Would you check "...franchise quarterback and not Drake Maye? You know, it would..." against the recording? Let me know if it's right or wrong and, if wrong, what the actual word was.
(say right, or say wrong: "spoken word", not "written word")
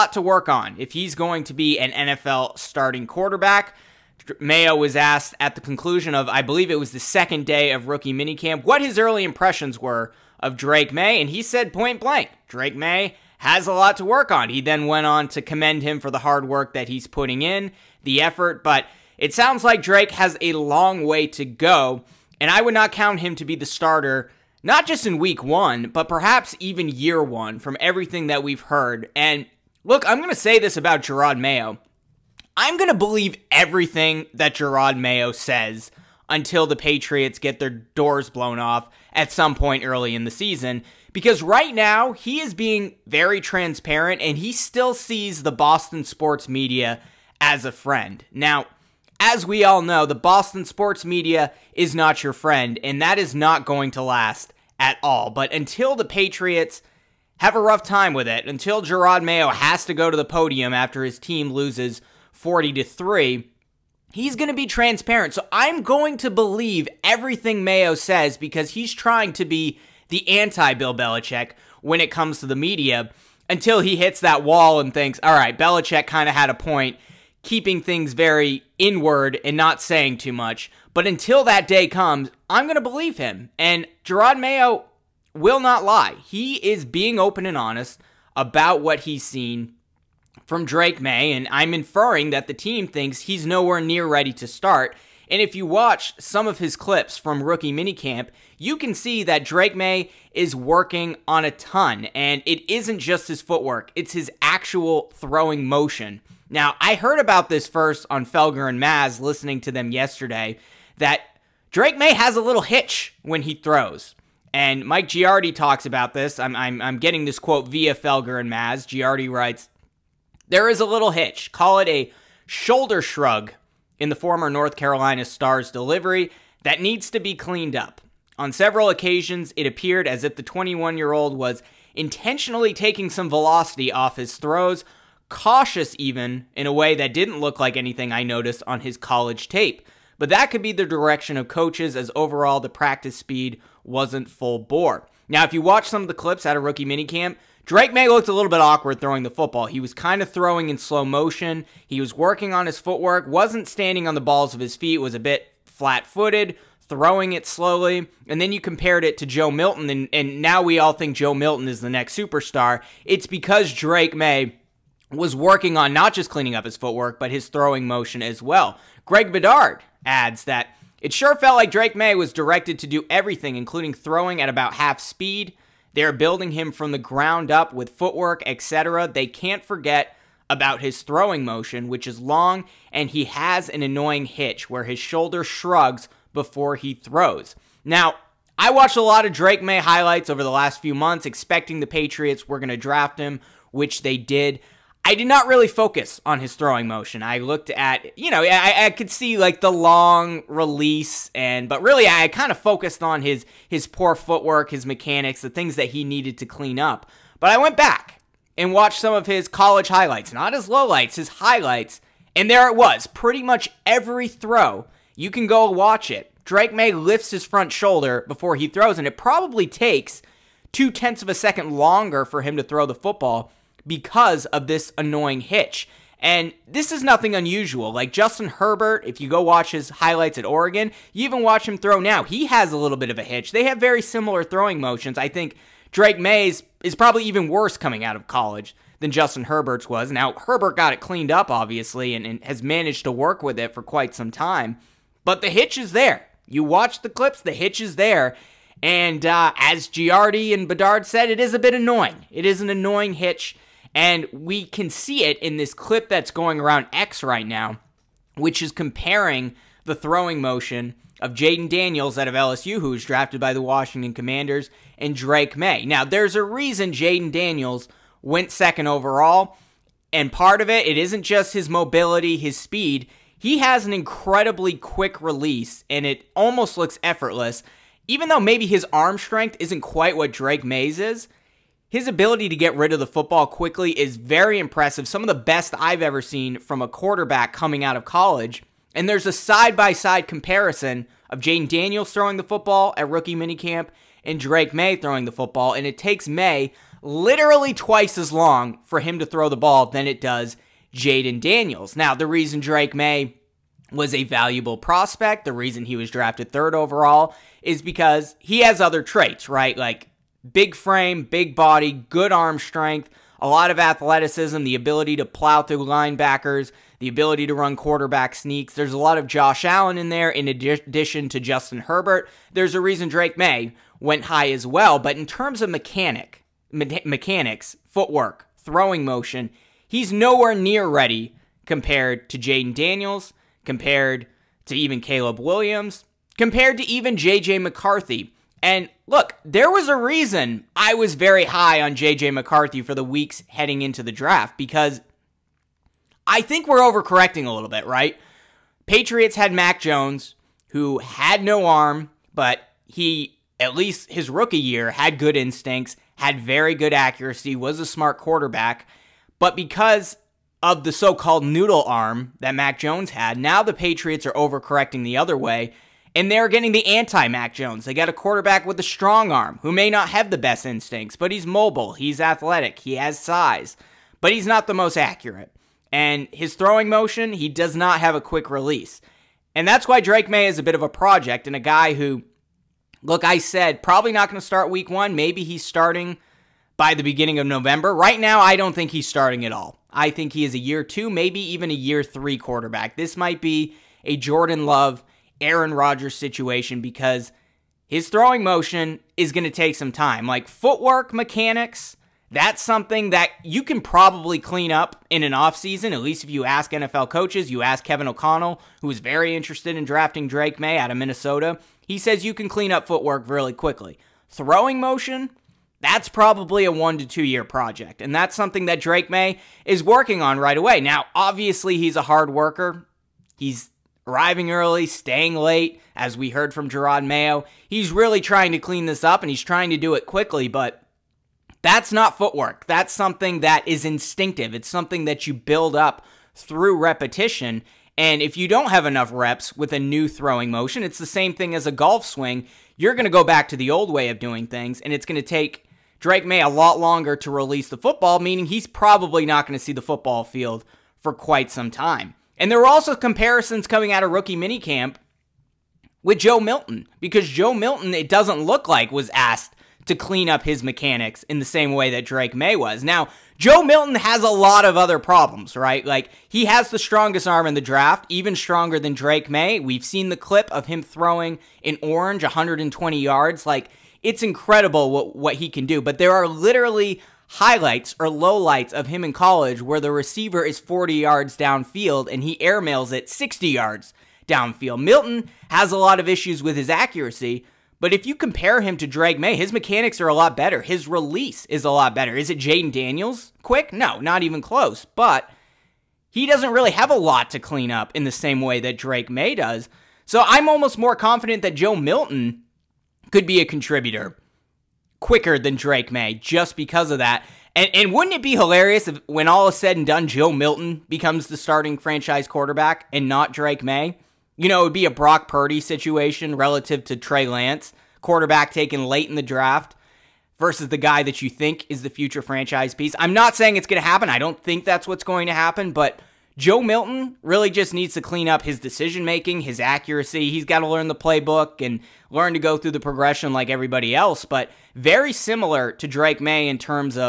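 right.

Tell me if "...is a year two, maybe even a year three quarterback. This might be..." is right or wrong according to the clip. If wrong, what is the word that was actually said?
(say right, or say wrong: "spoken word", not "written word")
right.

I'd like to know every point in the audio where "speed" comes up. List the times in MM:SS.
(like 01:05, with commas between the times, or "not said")
02:23, 02:54, 04:32.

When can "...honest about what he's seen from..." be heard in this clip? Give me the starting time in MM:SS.
01:27.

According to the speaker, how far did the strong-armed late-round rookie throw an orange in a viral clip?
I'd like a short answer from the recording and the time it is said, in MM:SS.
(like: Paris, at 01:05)
120 yards, at 07:52.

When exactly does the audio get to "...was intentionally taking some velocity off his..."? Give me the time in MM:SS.
02:11.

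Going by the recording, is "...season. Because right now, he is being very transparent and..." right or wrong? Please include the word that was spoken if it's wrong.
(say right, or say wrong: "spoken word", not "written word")
right.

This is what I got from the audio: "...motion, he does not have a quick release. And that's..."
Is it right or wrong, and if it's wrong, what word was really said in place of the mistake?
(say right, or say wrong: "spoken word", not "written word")
right.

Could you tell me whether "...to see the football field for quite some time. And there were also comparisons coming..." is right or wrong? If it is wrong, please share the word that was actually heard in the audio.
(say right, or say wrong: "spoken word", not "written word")
right.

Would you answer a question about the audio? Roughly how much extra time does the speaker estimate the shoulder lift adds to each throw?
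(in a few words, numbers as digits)
two tenths of a second.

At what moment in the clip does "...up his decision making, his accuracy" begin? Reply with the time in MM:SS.
08:48.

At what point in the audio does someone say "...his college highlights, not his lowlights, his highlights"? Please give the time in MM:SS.
03:29.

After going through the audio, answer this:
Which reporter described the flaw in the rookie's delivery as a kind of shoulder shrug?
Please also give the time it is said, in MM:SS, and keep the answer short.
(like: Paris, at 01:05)
Mike Giardi, at 01:54.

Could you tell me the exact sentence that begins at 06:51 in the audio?
He says you can clean up footwork really quickly.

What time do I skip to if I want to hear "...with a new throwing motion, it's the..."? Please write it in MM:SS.
07:19.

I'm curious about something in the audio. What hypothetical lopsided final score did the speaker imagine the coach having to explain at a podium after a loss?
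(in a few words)
40 to 3.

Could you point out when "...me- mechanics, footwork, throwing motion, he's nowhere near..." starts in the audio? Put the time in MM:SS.
05:26.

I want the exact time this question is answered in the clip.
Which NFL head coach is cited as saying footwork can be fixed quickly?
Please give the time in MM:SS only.
06:47.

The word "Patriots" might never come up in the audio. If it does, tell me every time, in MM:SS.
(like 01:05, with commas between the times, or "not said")
00:36, 00:56, 03:11, 05:48, 06:03.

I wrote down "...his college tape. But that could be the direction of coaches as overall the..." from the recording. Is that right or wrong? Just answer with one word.
right.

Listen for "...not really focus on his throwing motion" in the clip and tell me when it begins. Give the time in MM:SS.
03:15.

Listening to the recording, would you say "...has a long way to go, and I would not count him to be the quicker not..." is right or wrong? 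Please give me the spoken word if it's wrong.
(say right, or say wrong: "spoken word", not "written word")
wrong: "starter", not "quicker".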